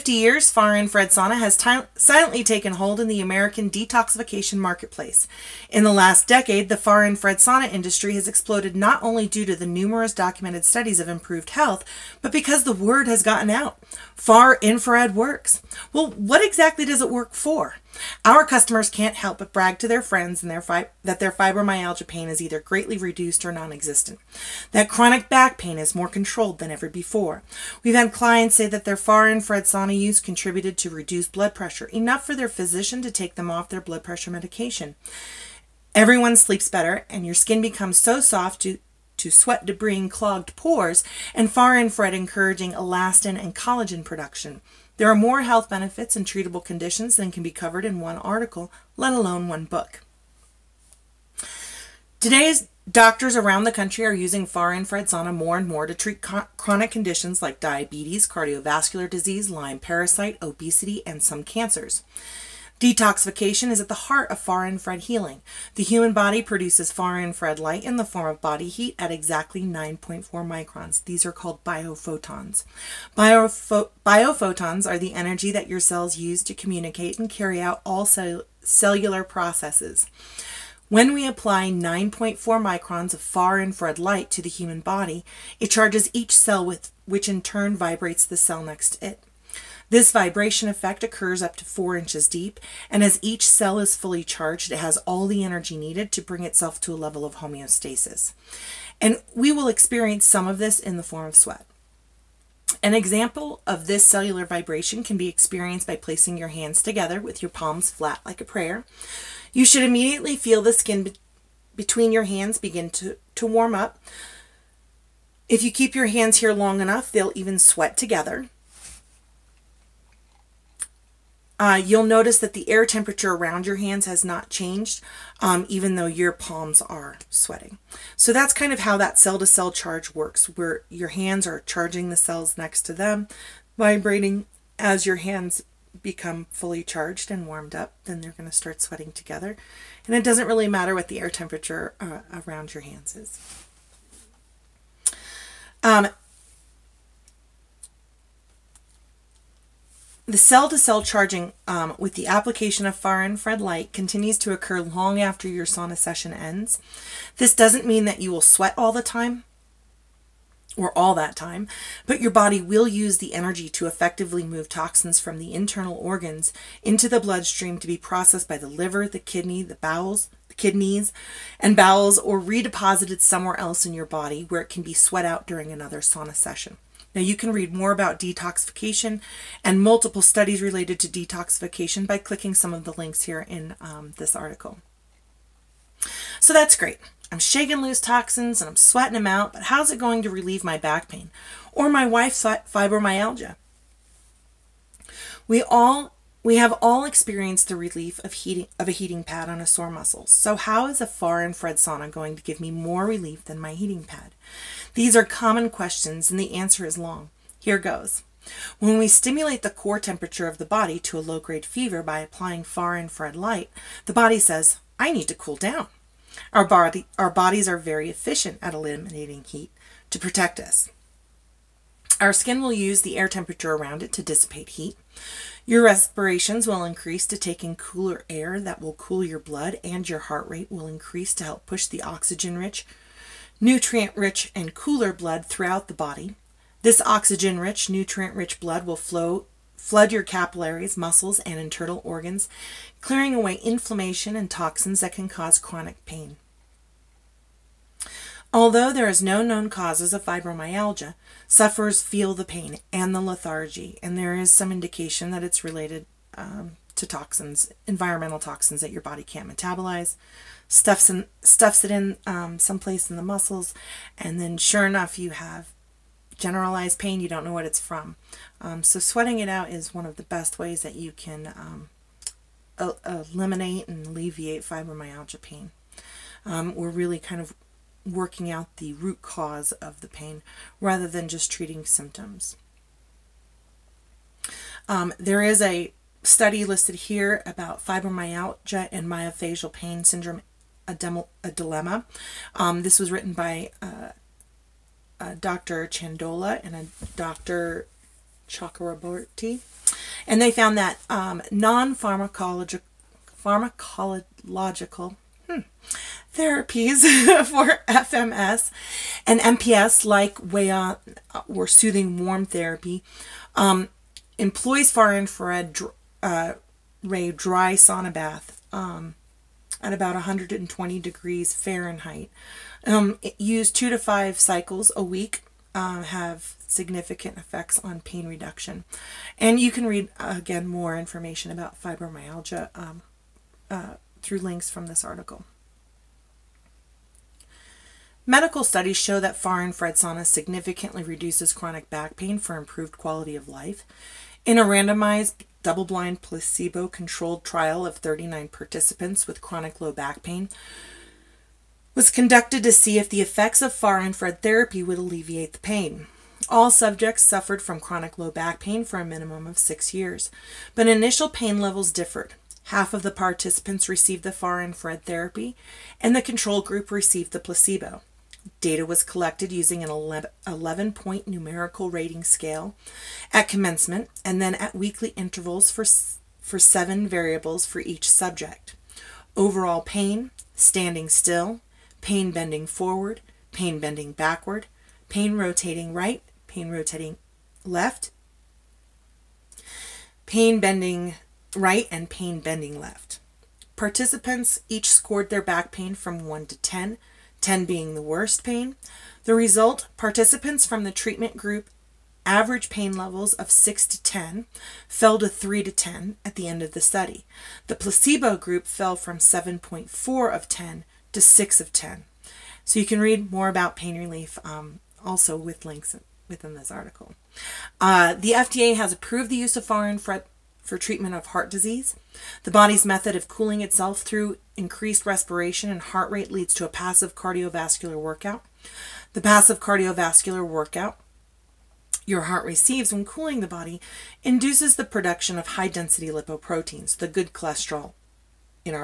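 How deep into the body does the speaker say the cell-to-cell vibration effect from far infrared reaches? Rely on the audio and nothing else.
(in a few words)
four inches.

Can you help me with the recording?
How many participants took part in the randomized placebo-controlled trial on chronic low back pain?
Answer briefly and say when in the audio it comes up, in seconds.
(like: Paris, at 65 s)
39, at 347 s.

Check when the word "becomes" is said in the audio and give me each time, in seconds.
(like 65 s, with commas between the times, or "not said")
37 s, 136 s.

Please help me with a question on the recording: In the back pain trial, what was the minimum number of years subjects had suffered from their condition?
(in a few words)
six years.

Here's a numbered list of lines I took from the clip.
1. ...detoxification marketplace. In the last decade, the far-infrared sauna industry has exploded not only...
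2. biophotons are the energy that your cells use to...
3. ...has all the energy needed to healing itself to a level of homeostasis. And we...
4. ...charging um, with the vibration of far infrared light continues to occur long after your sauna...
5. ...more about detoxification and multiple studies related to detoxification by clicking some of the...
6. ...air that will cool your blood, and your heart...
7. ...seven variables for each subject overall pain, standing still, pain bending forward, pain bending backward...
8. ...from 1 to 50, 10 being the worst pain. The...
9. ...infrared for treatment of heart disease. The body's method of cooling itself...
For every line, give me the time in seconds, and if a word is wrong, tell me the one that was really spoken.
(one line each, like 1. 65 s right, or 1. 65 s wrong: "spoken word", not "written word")
1. 3 s right
2. 73 s right
3. 94 s wrong: "bring", not "healing"
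4. 151 s wrong: "application", not "vibration"
5. 177 s right
6. 228 s right
7. 376 s right
8. 395 s wrong: "10", not "50"
9. 419 s right.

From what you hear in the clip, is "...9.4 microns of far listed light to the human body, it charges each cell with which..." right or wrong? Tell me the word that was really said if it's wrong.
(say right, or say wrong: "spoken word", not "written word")
wrong: "infrared", not "listed".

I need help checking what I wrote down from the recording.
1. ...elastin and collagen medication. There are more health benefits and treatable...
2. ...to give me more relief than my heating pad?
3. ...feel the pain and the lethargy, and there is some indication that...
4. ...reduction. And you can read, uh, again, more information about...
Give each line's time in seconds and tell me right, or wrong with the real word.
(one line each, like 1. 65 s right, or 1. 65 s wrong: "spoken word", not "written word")
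1. 42 s wrong: "production", not "medication"
2. 202 s right
3. 252 s right
4. 328 s right.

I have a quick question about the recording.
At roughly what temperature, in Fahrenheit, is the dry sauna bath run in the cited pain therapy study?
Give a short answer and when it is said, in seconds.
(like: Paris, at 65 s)
120 degrees, at 320 s.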